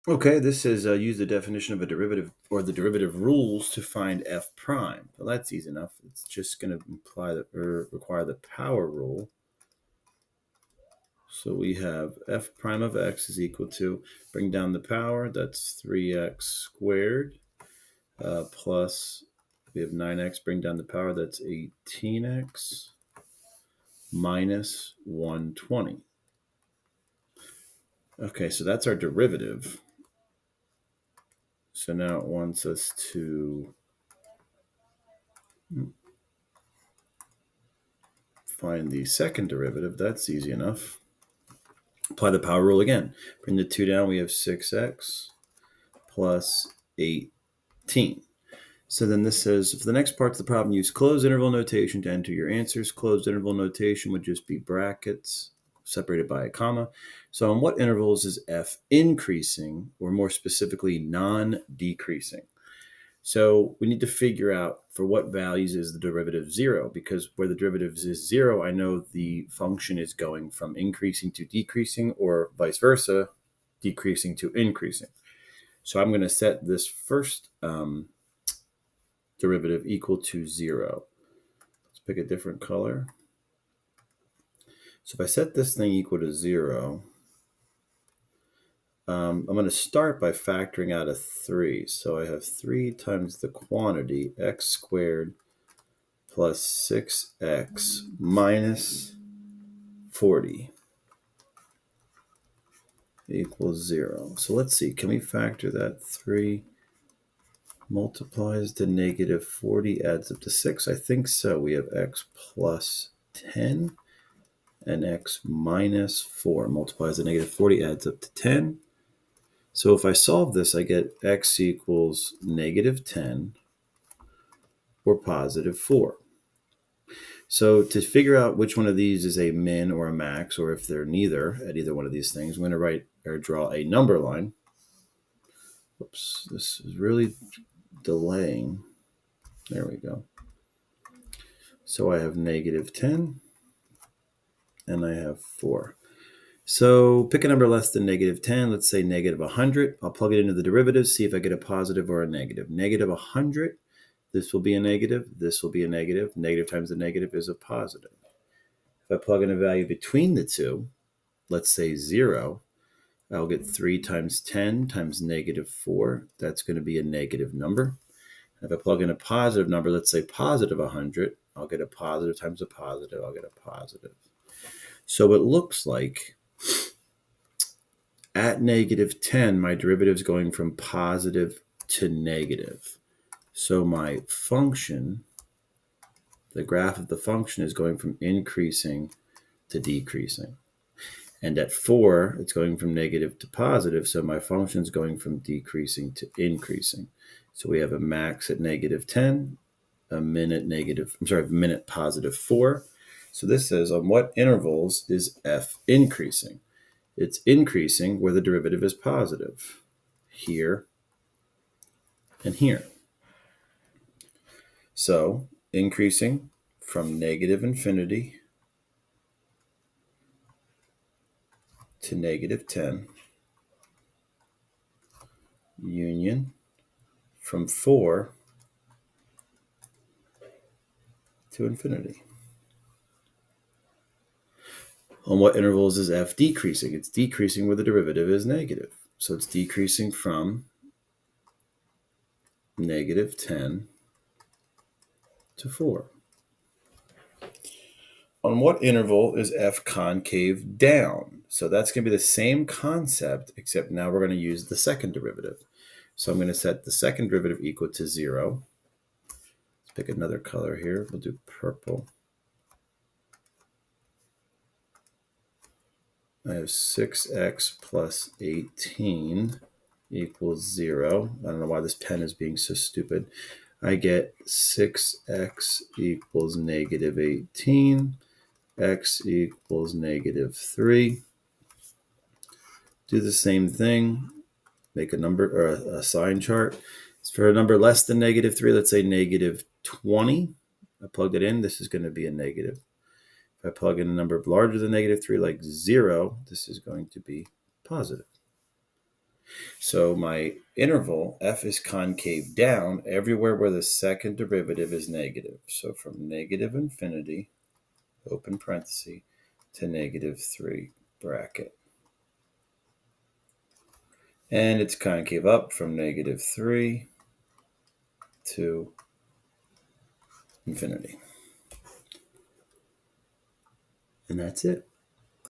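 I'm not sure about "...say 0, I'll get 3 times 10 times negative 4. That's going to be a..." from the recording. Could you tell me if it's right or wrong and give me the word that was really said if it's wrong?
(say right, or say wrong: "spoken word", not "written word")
right.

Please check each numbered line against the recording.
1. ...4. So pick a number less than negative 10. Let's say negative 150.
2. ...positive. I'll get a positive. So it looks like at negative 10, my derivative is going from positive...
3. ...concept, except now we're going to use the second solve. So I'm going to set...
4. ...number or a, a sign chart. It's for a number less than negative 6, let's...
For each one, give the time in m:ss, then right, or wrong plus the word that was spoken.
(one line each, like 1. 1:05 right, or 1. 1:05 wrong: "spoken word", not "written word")
1. 2:25 wrong: "100", not "150"
2. 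2:52 right
3. 4:12 wrong: "derivative", not "solve"
4. 4:45 wrong: "3", not "6".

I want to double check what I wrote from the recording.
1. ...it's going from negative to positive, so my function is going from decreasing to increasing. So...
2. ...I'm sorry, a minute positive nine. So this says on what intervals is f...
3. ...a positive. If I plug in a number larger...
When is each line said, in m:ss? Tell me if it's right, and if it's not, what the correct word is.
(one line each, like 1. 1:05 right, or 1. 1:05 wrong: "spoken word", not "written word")
1. 3:12 right
2. 3:21 wrong: "four", not "nine"
3. 4:52 wrong: "negative", not "positive".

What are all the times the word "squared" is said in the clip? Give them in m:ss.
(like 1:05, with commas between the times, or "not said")
0:16, 1:34.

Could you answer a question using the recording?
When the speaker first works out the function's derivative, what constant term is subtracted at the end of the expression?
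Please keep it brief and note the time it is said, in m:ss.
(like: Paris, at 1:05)
120, at 0:25.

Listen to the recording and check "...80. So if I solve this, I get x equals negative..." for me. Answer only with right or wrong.
wrong.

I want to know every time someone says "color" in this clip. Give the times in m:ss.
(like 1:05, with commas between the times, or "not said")
1:22, 4:20.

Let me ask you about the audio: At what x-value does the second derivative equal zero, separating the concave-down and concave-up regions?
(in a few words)
-3.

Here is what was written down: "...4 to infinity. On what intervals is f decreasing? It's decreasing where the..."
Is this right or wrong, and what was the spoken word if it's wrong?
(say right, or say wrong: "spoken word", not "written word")
right.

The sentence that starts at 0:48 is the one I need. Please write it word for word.
So then this says, for the next part of the problem, use closed interval notation to enter your answers.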